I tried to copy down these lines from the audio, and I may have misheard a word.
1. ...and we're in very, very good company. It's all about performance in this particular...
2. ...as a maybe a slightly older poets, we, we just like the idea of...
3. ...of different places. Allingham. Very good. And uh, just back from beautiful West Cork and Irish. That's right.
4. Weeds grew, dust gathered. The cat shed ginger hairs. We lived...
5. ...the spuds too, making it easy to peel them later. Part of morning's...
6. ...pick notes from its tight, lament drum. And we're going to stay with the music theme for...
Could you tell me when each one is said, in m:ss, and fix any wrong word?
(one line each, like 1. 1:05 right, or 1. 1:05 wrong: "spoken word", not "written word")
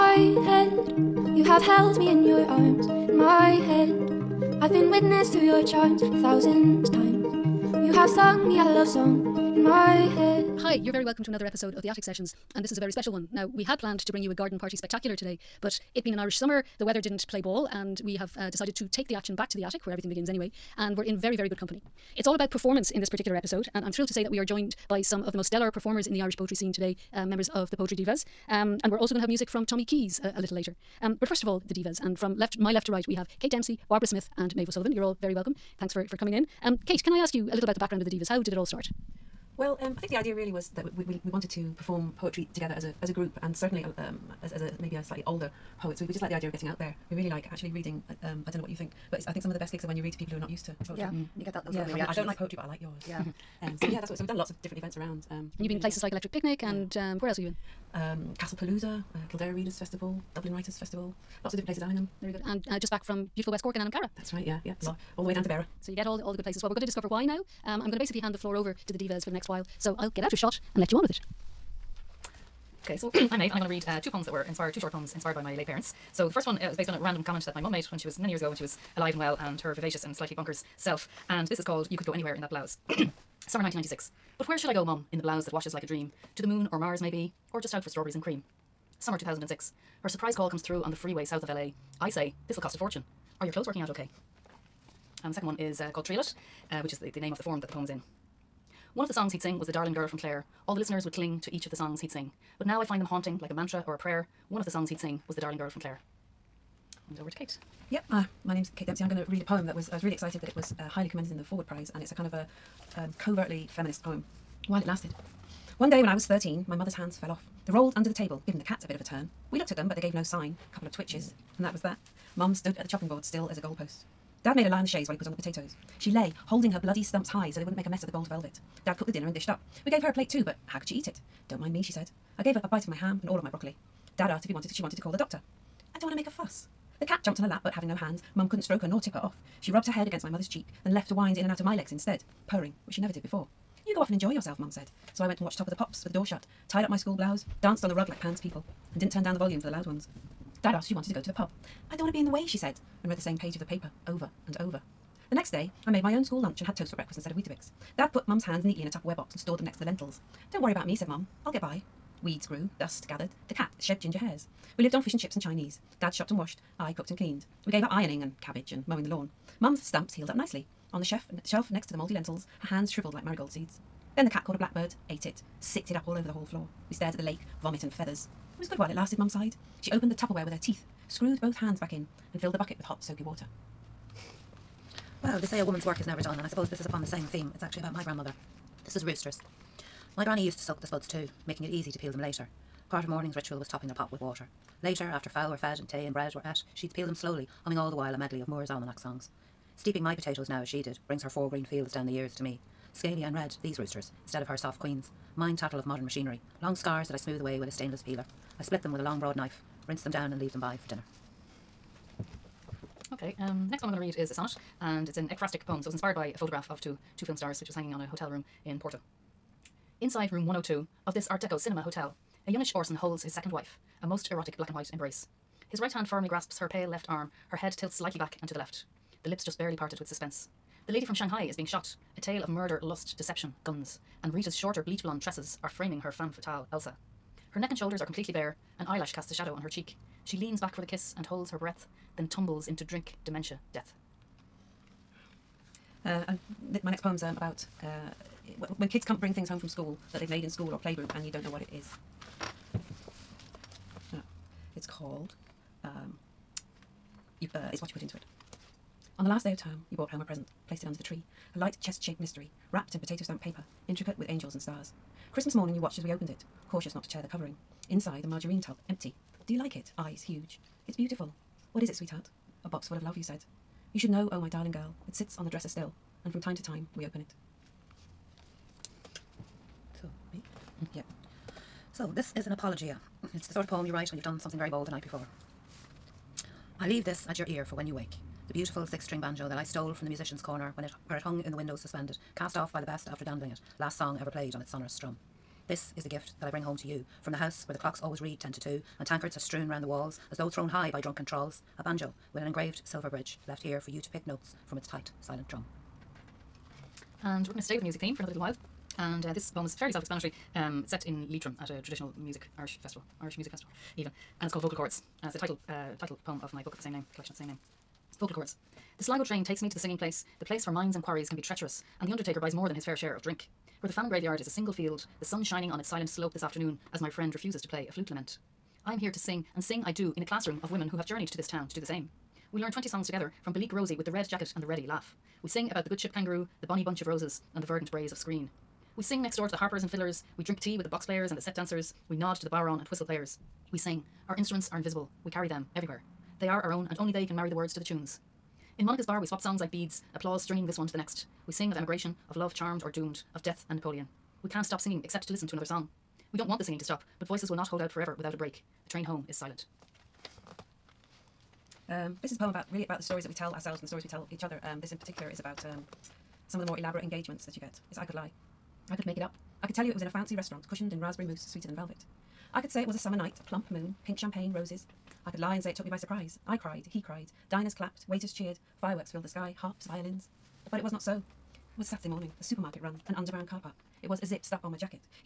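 1. 0:20 right
2. 0:44 right
3. 1:01 wrong: "Cara", not "Irish"
4. 2:42 right
5. 3:10 right
6. 5:04 wrong: "silent", not "lament".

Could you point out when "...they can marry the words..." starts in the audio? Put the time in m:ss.
5:47.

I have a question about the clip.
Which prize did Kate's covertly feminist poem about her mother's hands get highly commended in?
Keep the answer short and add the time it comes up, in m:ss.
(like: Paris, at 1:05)
Forward Prize, at 1:51.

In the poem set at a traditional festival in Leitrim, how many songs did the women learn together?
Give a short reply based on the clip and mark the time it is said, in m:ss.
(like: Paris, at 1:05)
20, at 5:32.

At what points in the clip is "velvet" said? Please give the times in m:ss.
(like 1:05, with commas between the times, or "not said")
2:08, 6:11.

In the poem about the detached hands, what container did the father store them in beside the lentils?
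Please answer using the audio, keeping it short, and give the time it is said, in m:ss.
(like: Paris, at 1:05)
Tupperware box, at 2:38.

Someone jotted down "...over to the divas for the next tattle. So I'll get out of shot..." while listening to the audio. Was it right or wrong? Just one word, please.
wrong.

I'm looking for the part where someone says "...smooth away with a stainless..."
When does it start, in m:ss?
3:27.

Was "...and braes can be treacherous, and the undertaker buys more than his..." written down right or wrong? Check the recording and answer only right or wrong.
wrong.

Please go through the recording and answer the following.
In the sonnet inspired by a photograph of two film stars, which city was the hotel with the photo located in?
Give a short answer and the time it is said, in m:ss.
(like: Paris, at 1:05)
Porto, at 3:38.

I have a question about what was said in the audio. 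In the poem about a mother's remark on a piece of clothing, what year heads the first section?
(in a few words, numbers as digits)
1996.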